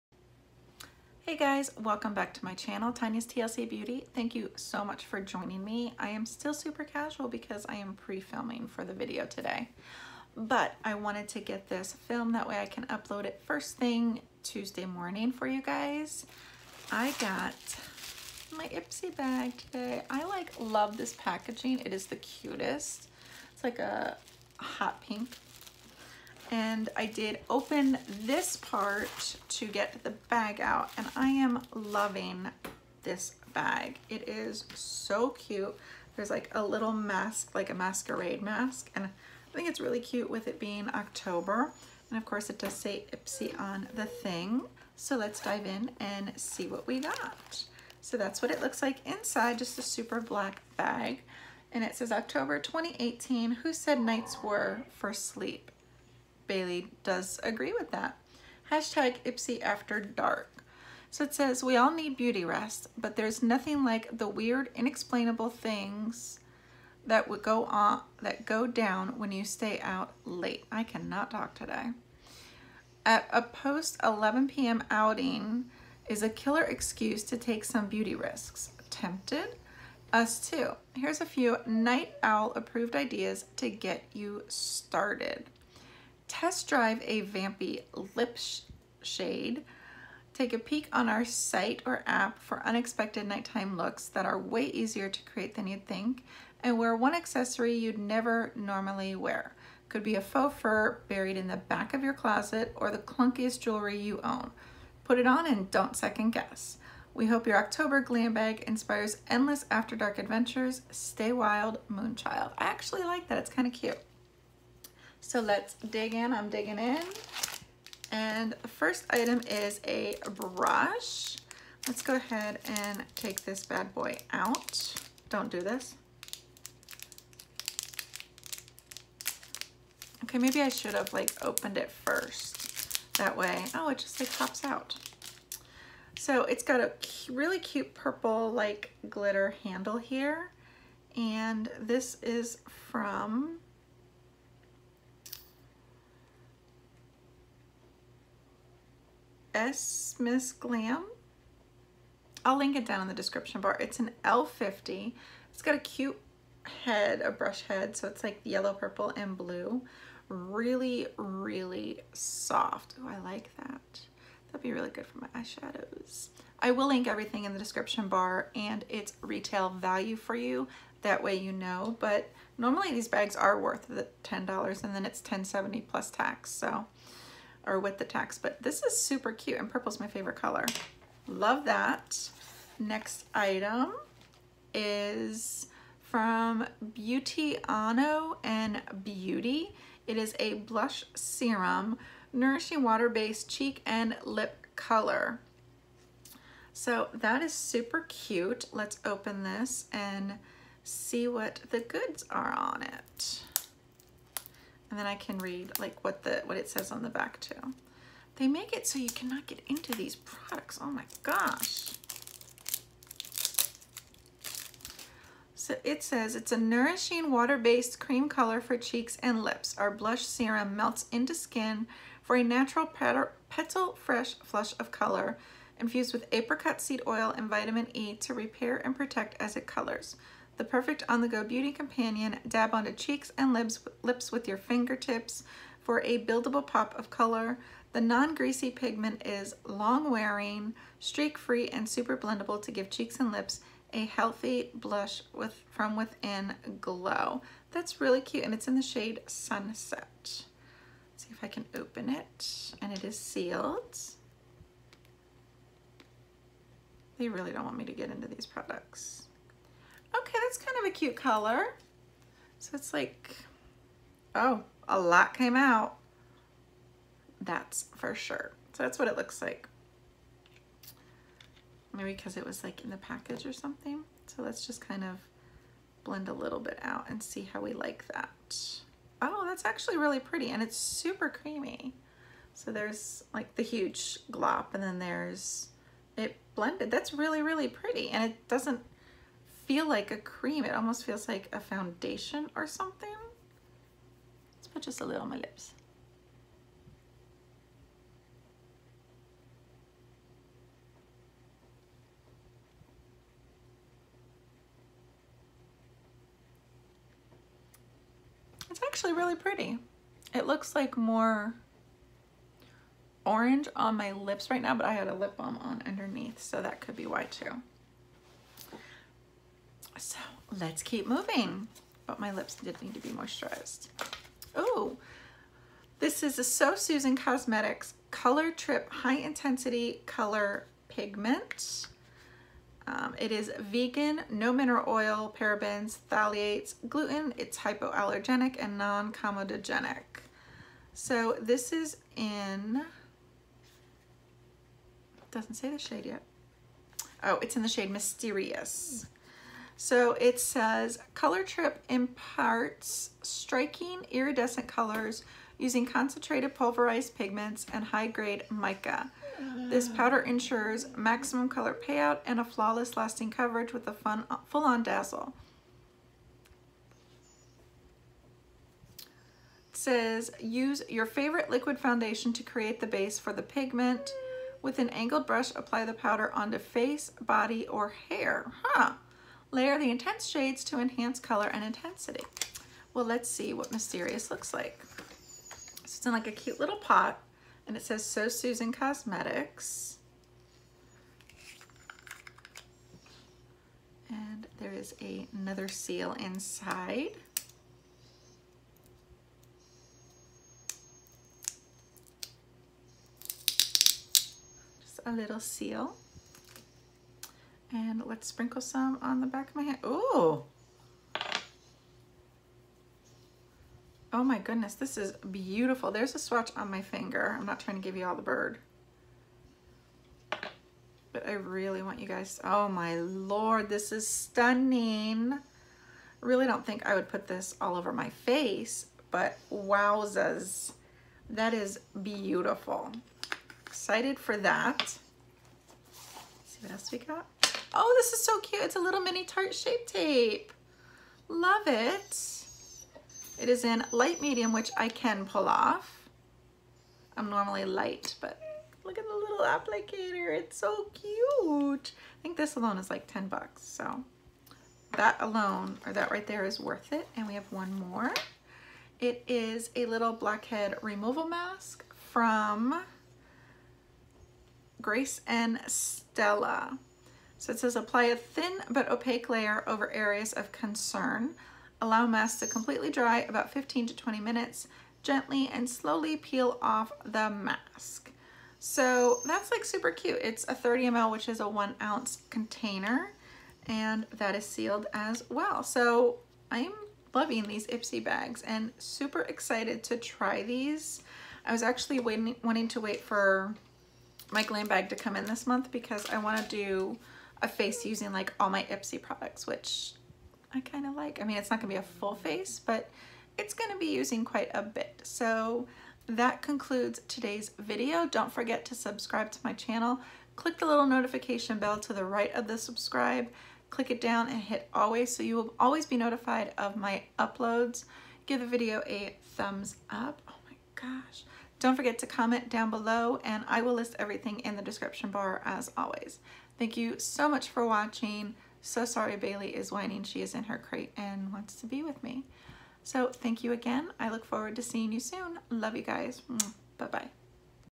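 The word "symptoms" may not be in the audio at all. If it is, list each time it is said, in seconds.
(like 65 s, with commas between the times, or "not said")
not said.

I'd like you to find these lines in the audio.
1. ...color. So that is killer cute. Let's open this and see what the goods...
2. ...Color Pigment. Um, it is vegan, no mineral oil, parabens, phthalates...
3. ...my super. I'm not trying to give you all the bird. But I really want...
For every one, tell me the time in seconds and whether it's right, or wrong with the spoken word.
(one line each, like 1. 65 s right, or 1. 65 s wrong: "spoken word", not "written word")
1. 194 s wrong: "super", not "killer"
2. 330 s right
3. 416 s wrong: "finger", not "super".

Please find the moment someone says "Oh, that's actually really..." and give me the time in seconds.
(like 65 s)
279 s.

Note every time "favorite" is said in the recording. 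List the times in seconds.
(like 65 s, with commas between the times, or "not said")
180 s, 371 s.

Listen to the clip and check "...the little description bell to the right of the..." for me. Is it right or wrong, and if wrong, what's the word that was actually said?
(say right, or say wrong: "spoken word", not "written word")
wrong: "notification", not "description".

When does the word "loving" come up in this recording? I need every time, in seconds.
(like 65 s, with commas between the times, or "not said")
31 s, 487 s.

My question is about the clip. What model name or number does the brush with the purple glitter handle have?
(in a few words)
L50.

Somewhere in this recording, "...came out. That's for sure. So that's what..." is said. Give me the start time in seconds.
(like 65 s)
265 s.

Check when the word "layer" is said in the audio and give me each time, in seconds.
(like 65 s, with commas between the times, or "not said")
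379 s, 469 s.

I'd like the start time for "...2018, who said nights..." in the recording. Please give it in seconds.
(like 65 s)
52 s.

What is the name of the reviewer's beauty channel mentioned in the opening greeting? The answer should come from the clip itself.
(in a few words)
Tanya's TLC Beauty.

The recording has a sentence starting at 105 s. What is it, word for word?
Put it on and don't second guess.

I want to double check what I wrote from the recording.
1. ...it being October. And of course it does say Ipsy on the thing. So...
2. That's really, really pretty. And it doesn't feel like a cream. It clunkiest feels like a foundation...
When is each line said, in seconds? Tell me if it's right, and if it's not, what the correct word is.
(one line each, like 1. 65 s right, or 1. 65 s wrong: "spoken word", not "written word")
1. 40 s right
2. 286 s wrong: "almost", not "clunkiest".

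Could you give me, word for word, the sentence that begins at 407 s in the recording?
And let's sprinkle some on the back of my hand.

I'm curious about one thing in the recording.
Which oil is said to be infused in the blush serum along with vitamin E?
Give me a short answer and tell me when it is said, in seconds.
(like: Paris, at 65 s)
apricot seed oil, at 226 s.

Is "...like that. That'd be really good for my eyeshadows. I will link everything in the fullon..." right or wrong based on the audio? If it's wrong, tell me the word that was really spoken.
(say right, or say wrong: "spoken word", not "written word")
wrong: "description", not "fullon".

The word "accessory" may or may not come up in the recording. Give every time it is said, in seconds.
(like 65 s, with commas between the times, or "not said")
97 s.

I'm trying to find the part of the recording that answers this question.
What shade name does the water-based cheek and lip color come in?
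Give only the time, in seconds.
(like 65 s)
249 s.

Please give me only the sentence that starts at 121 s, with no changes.
Let's go ahead and take this bad boy out.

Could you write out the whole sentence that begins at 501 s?
I mean, it's not gonna be a full face, but it's gonna be using quite a bit.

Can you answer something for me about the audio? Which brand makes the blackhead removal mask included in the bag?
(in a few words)
Grace and Stella.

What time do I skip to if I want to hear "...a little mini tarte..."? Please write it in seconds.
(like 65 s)
438 s.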